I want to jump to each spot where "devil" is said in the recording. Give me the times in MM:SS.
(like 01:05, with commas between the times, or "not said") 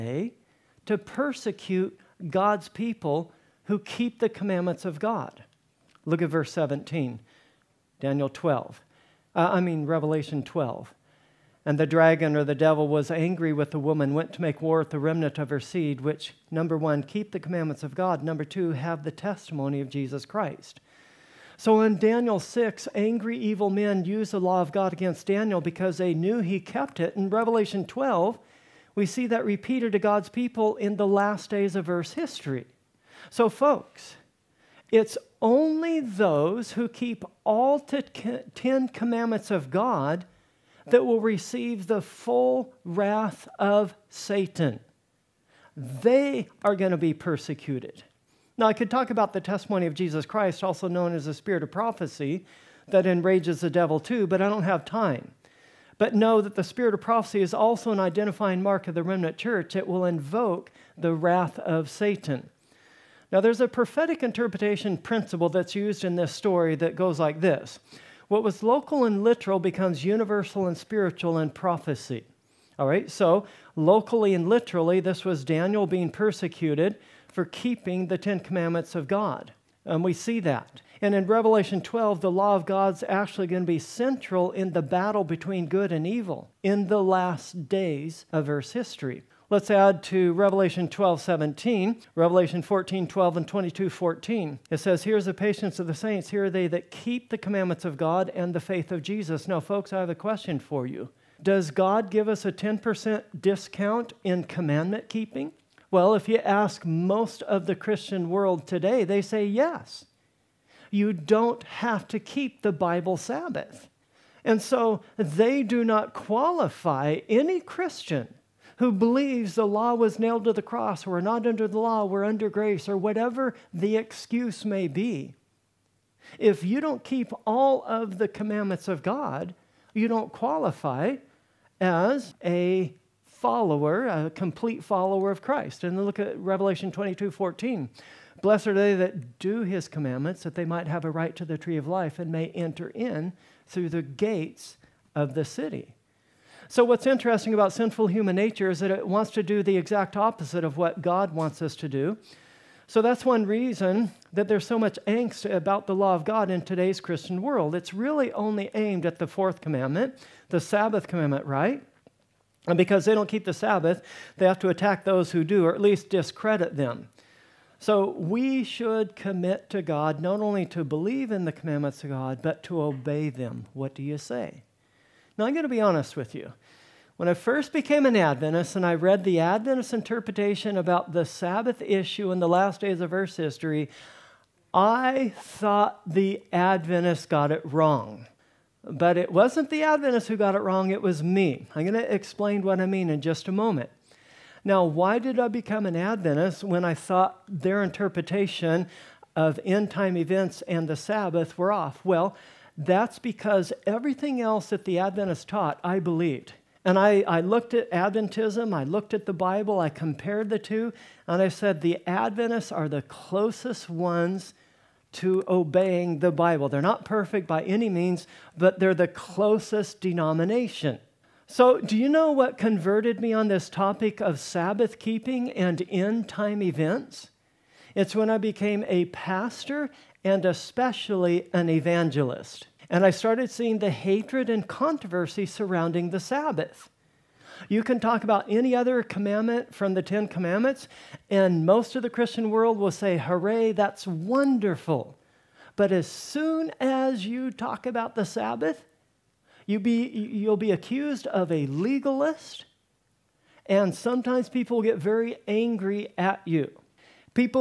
00:12, 00:53.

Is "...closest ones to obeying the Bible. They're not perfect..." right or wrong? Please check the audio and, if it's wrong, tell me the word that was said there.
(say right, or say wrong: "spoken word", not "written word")
right.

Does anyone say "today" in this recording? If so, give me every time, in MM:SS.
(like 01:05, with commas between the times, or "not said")
01:48, 02:36.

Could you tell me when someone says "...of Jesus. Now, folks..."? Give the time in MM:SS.
01:38.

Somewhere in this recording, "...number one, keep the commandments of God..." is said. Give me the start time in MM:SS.
00:16.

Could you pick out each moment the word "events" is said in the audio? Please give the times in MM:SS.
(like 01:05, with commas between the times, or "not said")
03:20, 03:46.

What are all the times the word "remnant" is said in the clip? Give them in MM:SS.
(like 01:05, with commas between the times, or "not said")
00:14, 00:59.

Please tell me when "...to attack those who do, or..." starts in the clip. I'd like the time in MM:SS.
02:44.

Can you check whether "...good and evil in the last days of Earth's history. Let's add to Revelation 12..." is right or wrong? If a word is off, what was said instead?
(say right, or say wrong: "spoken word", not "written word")
right.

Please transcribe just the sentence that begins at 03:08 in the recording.
But it wasn't the Adventists who got it wrong, it was me.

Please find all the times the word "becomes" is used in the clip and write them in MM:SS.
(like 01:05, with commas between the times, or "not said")
01:09, 03:15.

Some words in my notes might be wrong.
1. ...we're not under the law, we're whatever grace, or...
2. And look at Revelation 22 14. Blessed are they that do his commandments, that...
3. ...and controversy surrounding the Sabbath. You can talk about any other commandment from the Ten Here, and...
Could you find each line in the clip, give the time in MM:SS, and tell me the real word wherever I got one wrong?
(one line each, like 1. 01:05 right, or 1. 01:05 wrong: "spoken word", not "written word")
1. 02:01 wrong: "under", not "whatever"
2. 02:15 right
3. 03:54 wrong: "Commandments", not "Here".